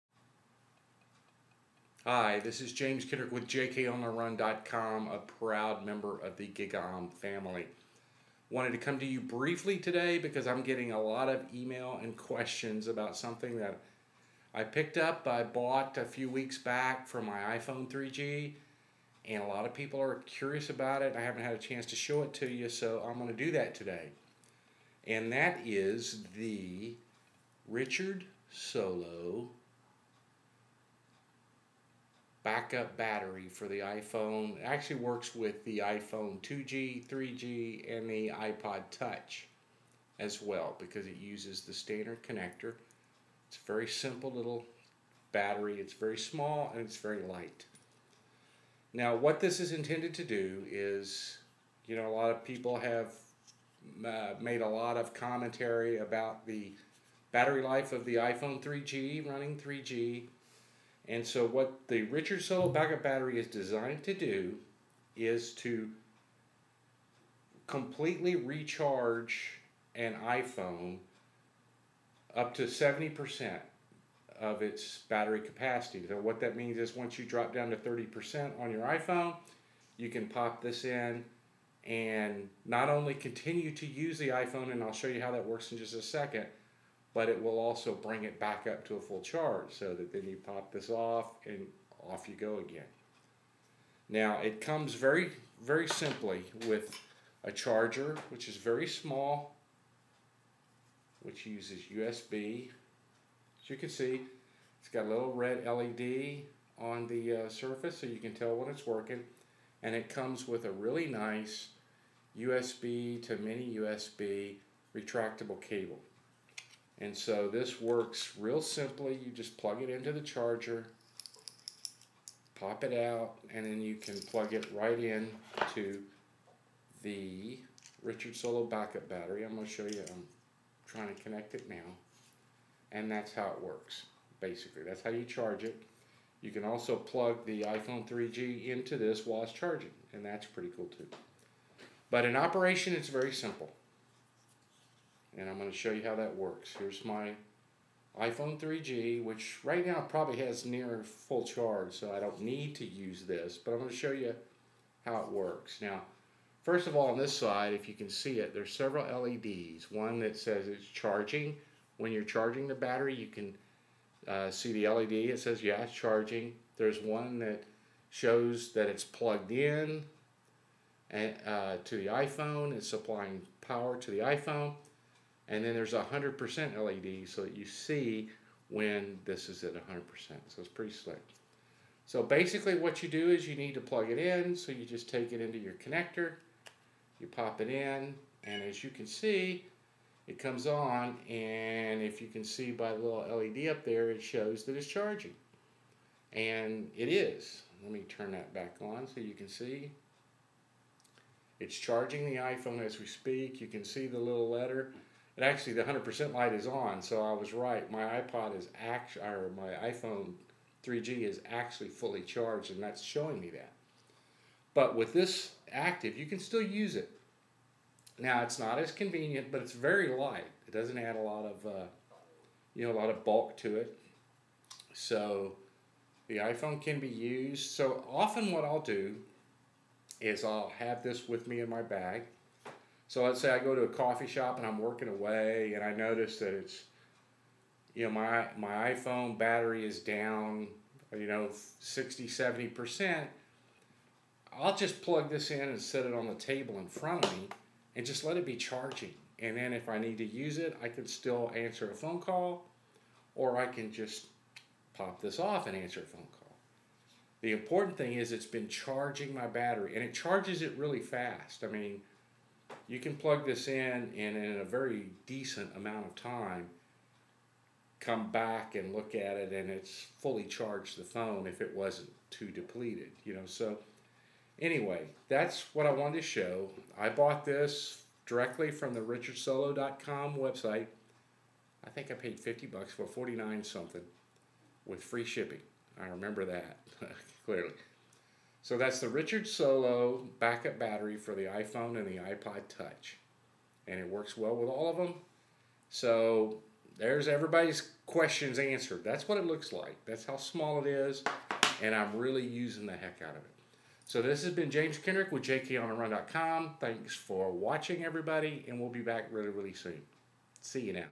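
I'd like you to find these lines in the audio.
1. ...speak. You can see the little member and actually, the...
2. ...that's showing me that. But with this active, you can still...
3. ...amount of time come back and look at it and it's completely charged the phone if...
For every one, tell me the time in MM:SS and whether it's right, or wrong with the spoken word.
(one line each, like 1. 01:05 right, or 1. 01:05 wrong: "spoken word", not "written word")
1. 03:23 wrong: "letter", not "member"
2. 03:32 right
3. 04:25 wrong: "fully", not "completely".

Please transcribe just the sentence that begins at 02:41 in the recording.
When you're charging the battery, you can uh, see the LED.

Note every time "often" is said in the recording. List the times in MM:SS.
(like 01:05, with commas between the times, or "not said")
03:48.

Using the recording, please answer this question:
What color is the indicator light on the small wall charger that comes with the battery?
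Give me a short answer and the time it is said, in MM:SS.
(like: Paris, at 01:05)
red, at 01:45.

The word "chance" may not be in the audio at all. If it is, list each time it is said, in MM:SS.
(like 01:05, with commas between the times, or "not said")
00:21.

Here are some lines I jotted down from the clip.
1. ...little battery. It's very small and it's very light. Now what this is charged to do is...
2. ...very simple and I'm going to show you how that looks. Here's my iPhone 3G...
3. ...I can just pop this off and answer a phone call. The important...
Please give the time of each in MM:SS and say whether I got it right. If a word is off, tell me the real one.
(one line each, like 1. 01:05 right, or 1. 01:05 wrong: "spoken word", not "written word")
1. 00:44 wrong: "intended", not "charged"
2. 02:23 wrong: "works", not "looks"
3. 04:13 right.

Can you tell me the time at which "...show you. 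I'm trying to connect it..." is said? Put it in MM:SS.
02:09.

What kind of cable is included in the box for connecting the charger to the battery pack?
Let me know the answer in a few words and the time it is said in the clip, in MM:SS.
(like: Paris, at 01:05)
USB to mini USB retractable cable, at 01:52.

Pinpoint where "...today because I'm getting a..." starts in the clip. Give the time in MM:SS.
00:09.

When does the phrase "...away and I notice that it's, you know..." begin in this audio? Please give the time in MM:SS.
03:55.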